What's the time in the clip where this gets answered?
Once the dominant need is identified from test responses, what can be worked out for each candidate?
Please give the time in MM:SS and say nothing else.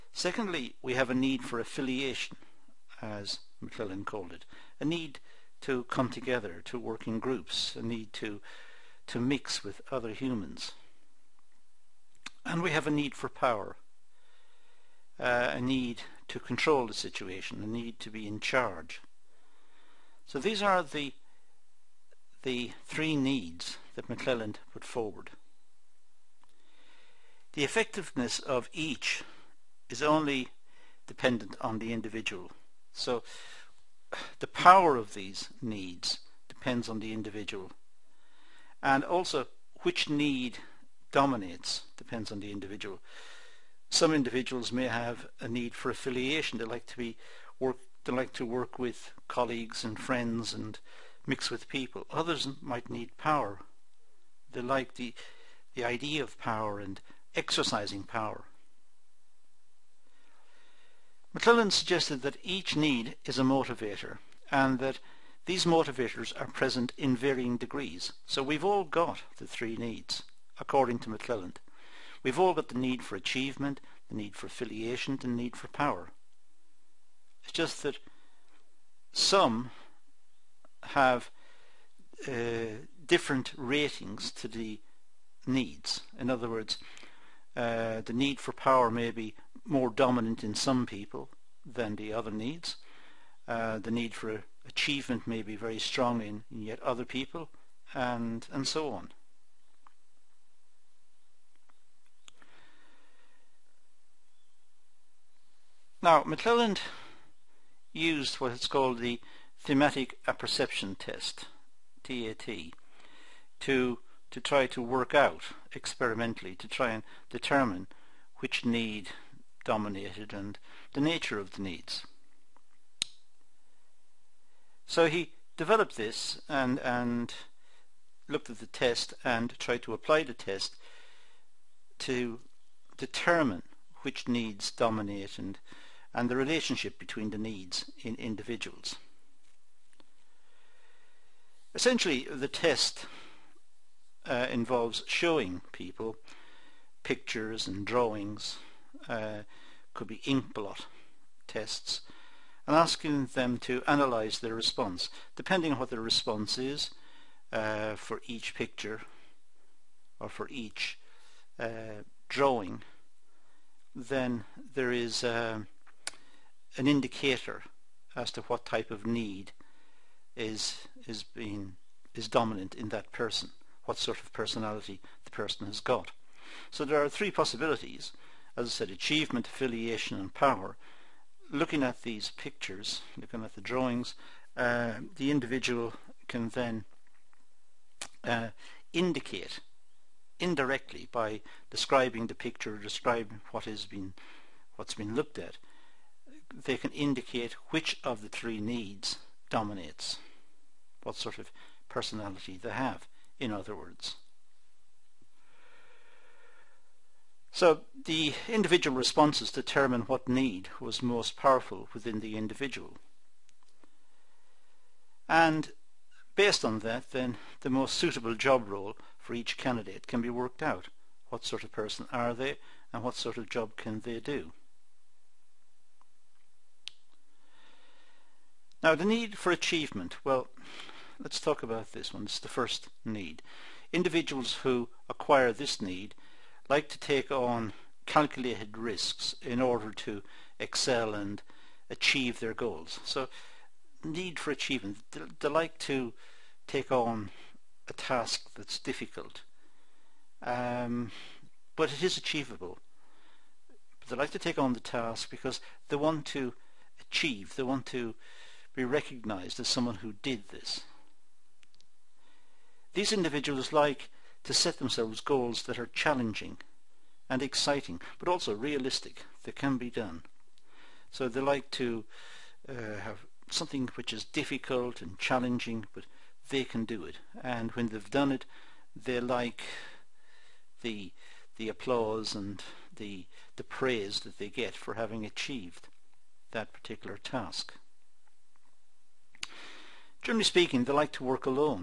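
03:37.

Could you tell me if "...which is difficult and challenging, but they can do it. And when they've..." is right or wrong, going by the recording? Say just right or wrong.
right.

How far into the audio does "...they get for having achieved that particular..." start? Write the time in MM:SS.
04:44.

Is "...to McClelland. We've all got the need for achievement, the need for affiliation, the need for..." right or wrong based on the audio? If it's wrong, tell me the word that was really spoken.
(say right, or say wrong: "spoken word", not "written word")
right.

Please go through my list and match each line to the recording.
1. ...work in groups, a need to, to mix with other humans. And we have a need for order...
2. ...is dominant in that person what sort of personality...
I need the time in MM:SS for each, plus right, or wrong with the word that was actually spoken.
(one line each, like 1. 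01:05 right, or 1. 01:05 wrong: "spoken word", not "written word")
1. 00:06 wrong: "power", not "order"
2. 02:52 right.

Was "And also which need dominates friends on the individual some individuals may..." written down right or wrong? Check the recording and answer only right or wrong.
wrong.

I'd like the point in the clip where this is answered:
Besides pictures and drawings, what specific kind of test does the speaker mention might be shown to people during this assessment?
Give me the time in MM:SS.
02:30.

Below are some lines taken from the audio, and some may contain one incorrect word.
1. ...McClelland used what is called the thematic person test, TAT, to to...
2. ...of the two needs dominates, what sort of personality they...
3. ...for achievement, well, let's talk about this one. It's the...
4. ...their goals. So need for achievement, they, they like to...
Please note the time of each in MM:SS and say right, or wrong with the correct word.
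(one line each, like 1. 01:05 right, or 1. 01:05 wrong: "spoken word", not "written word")
1. 01:46 wrong: "apperception", not "person"
2. 03:18 wrong: "three", not "two"
3. 03:49 right
4. 04:02 right.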